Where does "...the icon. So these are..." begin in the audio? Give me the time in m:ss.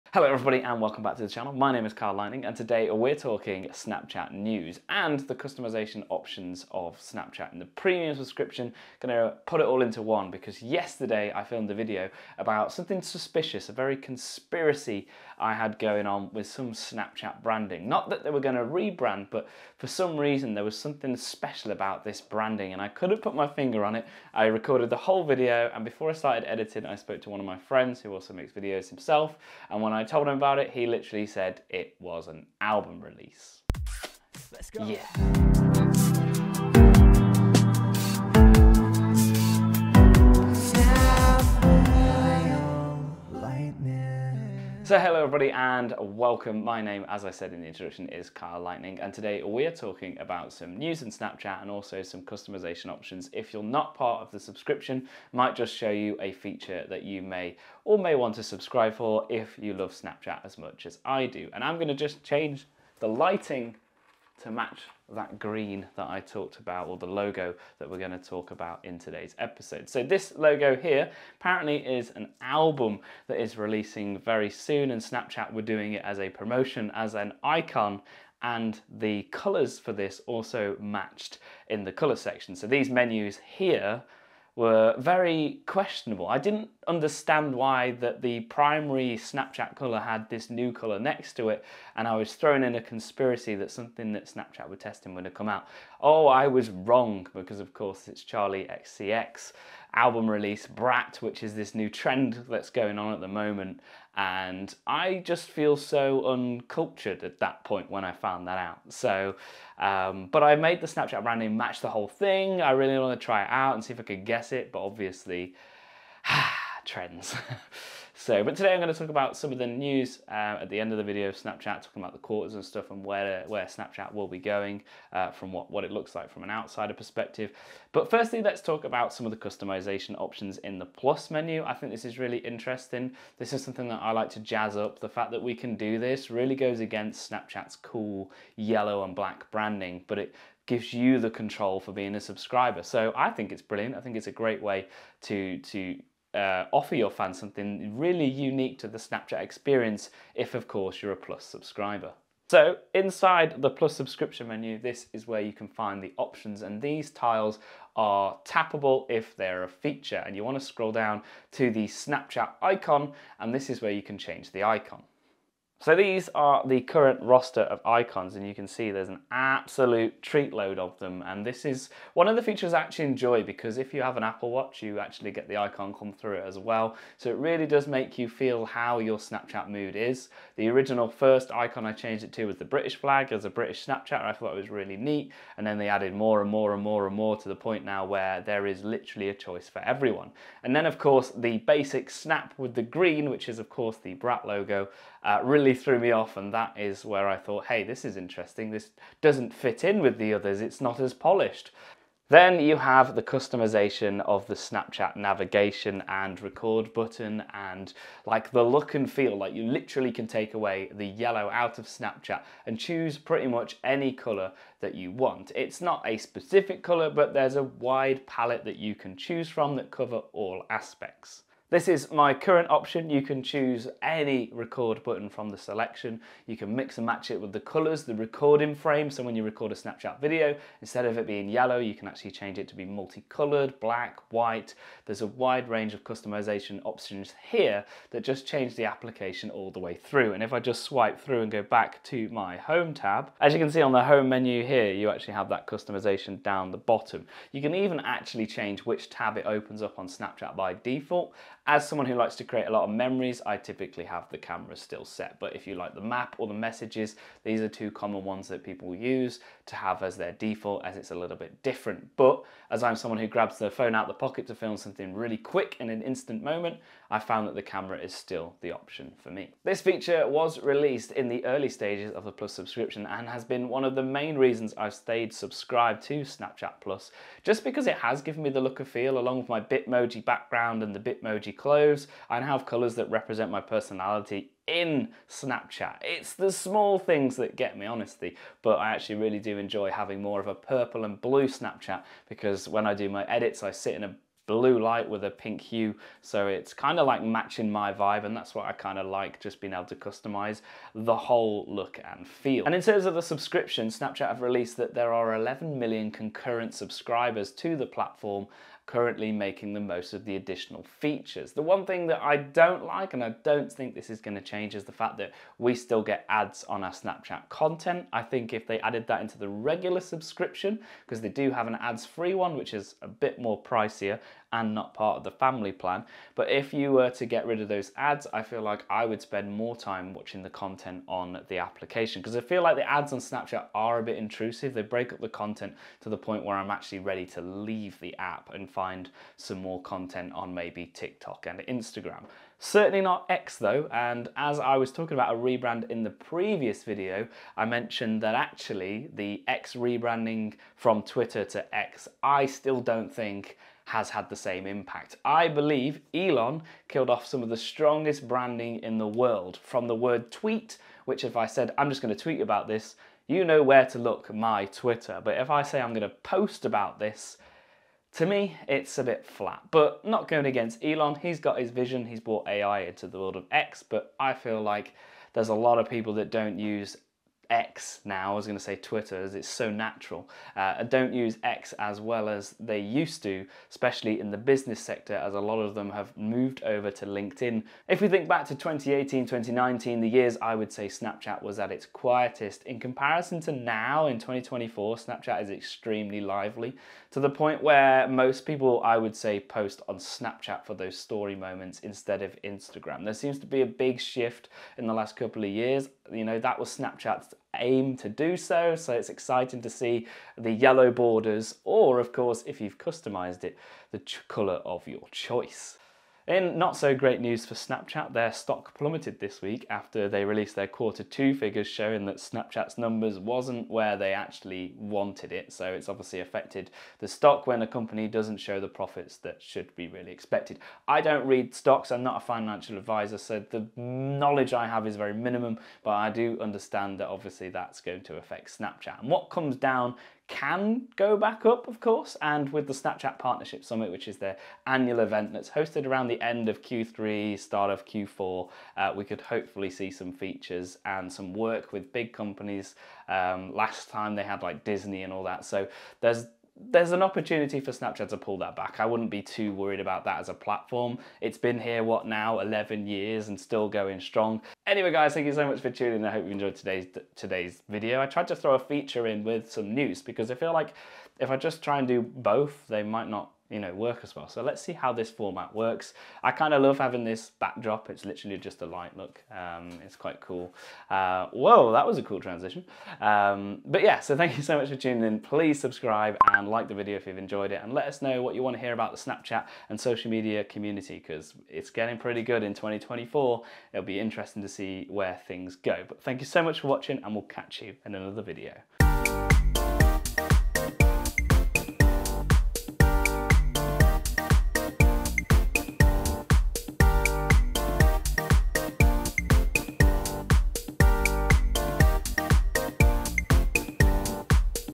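2:44.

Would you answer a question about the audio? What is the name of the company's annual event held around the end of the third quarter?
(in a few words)
Snapchat Partnership Summit.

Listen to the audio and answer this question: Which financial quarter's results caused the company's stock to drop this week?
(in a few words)
quarter two.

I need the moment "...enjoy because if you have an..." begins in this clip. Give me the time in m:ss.
2:53.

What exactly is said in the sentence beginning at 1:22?
So these menus here were very questionable.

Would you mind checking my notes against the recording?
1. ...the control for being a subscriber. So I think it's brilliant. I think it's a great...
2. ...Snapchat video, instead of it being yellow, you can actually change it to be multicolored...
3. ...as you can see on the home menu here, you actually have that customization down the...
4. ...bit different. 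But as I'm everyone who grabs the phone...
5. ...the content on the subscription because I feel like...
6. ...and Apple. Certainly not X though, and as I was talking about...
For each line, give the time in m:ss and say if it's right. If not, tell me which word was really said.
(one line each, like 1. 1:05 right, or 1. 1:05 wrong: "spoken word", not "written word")
1. 2:21 right
2. 3:49 right
3. 4:03 right
4. 4:21 wrong: "someone", not "everyone"
5. 5:30 wrong: "application", not "subscription"
6. 5:41 wrong: "Instagram", not "Apple".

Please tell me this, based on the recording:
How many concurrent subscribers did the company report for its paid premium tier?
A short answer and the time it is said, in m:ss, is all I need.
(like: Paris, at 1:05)
11 million, at 5:05.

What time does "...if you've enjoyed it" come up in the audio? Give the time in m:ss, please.
8:06.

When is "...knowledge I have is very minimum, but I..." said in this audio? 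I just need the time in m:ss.
7:13.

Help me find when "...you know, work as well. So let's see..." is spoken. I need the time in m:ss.
7:53.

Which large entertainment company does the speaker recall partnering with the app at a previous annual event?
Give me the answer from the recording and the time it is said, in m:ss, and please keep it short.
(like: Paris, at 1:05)
Disney, at 7:34.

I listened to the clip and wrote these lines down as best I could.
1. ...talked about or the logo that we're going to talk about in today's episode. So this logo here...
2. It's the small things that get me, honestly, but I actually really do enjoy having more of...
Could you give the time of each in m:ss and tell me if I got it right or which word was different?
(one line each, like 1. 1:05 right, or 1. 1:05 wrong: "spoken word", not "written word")
1. 1:06 right
2. 4:46 right.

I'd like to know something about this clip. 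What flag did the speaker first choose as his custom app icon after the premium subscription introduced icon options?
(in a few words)
British flag.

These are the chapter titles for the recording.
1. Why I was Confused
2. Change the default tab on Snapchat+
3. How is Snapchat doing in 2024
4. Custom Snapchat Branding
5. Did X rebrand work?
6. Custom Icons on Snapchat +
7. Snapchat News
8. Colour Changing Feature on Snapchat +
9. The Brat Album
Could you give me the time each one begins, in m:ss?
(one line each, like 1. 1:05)
1. 1:22
2. 4:09
3. 6:27
4. 2:10
5. 5:42
6. 2:33
7. 5:01
8. 3:20
9. 0:50.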